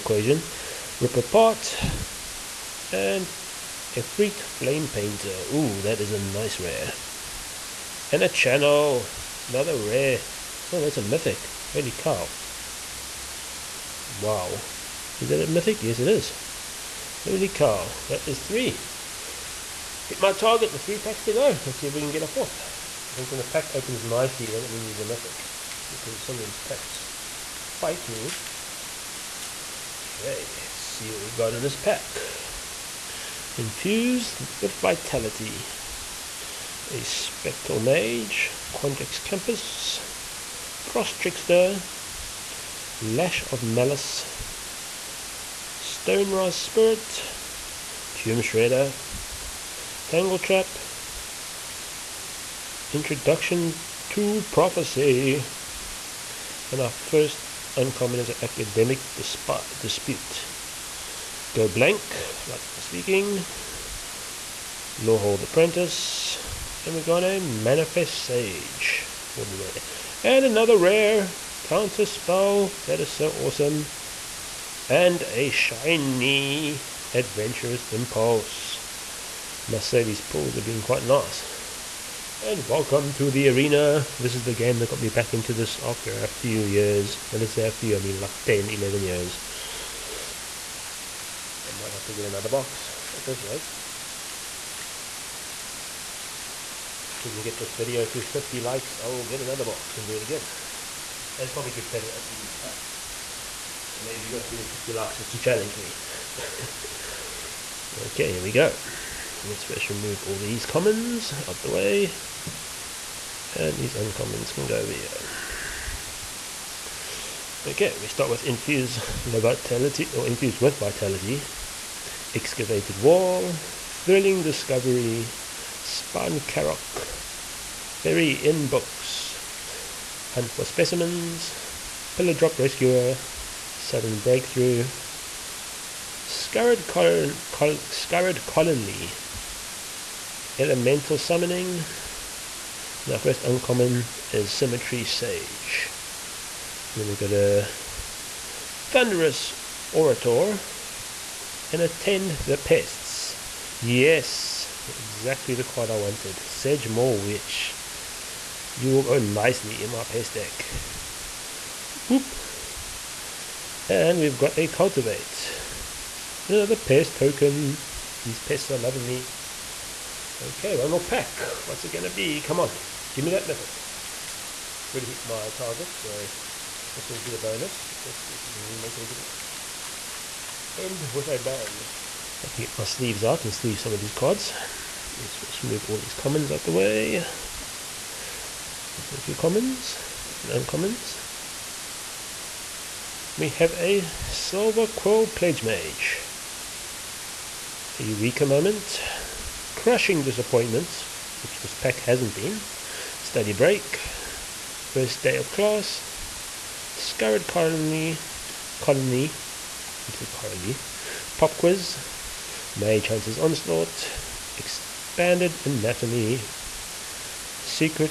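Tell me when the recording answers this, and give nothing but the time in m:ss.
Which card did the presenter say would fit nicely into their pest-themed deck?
2:36.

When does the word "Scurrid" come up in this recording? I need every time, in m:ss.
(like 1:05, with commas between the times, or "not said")
2:16, 3:26.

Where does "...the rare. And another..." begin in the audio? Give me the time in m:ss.
1:09.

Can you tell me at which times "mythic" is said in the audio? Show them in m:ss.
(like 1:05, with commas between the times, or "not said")
0:11, 0:15, 0:25, 2:53.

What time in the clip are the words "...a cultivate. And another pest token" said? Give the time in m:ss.
2:44.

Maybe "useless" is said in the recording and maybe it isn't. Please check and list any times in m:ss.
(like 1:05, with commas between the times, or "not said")
not said.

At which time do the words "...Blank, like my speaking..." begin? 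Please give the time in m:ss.
1:01.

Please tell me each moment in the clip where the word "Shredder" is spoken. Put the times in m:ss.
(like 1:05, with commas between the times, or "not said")
0:48.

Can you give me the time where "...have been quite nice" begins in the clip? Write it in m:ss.
1:20.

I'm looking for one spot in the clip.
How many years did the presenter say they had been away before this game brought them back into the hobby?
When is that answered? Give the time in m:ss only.
1:28.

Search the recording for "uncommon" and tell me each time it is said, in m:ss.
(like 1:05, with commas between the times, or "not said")
0:57, 1:53, 2:23, 3:10.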